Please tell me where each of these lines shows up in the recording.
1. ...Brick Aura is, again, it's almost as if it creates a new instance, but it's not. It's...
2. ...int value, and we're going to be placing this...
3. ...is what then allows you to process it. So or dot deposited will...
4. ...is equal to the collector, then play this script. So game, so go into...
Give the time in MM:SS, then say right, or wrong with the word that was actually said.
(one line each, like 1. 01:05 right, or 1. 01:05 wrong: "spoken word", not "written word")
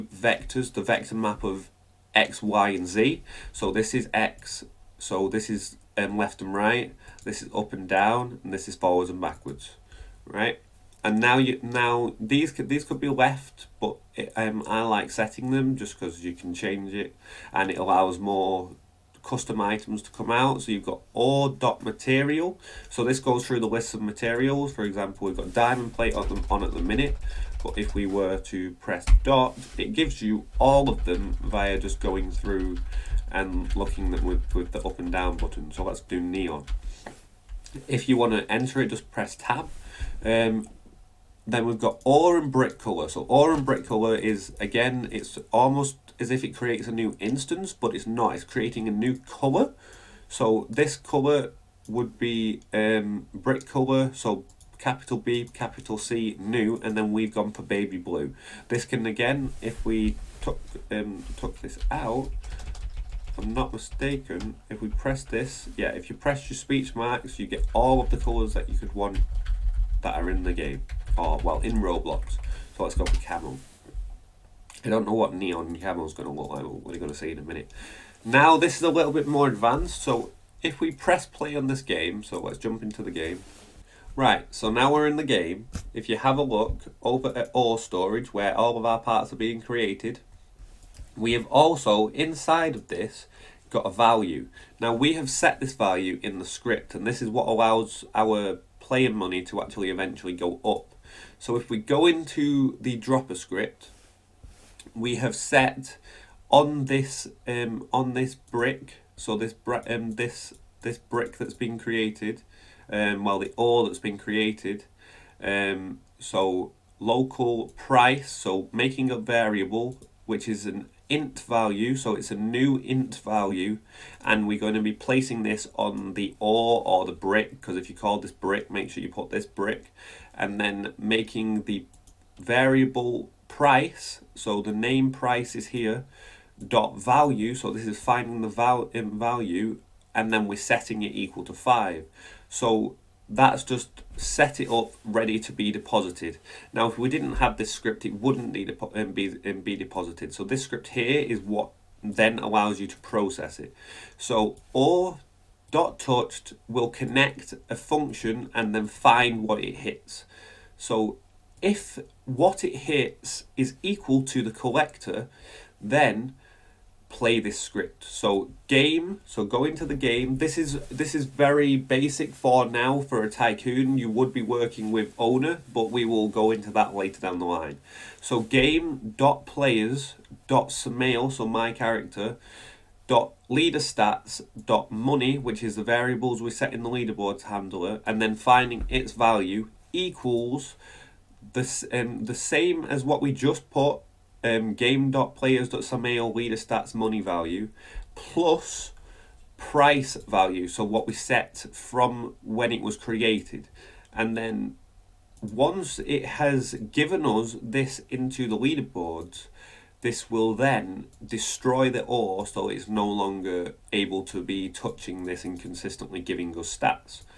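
1. 00:43 wrong: "Color", not "Aura"
2. 02:02 right
3. 02:31 wrong: "touched", not "deposited"
4. 02:43 right.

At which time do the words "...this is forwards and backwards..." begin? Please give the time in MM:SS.
00:08.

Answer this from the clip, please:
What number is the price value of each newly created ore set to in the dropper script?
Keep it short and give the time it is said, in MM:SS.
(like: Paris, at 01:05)
5, at 02:21.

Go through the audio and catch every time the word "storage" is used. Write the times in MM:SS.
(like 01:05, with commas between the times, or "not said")
01:27.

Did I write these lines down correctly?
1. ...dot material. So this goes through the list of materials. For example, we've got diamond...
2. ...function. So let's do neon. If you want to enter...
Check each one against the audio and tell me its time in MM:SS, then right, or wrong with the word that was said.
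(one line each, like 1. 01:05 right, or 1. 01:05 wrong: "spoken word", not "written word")
1. 00:21 right
2. 00:35 wrong: "button", not "function".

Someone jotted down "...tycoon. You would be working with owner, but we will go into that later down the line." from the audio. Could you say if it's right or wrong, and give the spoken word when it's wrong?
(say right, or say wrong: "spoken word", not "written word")
right.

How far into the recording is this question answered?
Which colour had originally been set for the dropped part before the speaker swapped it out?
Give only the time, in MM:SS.
00:57.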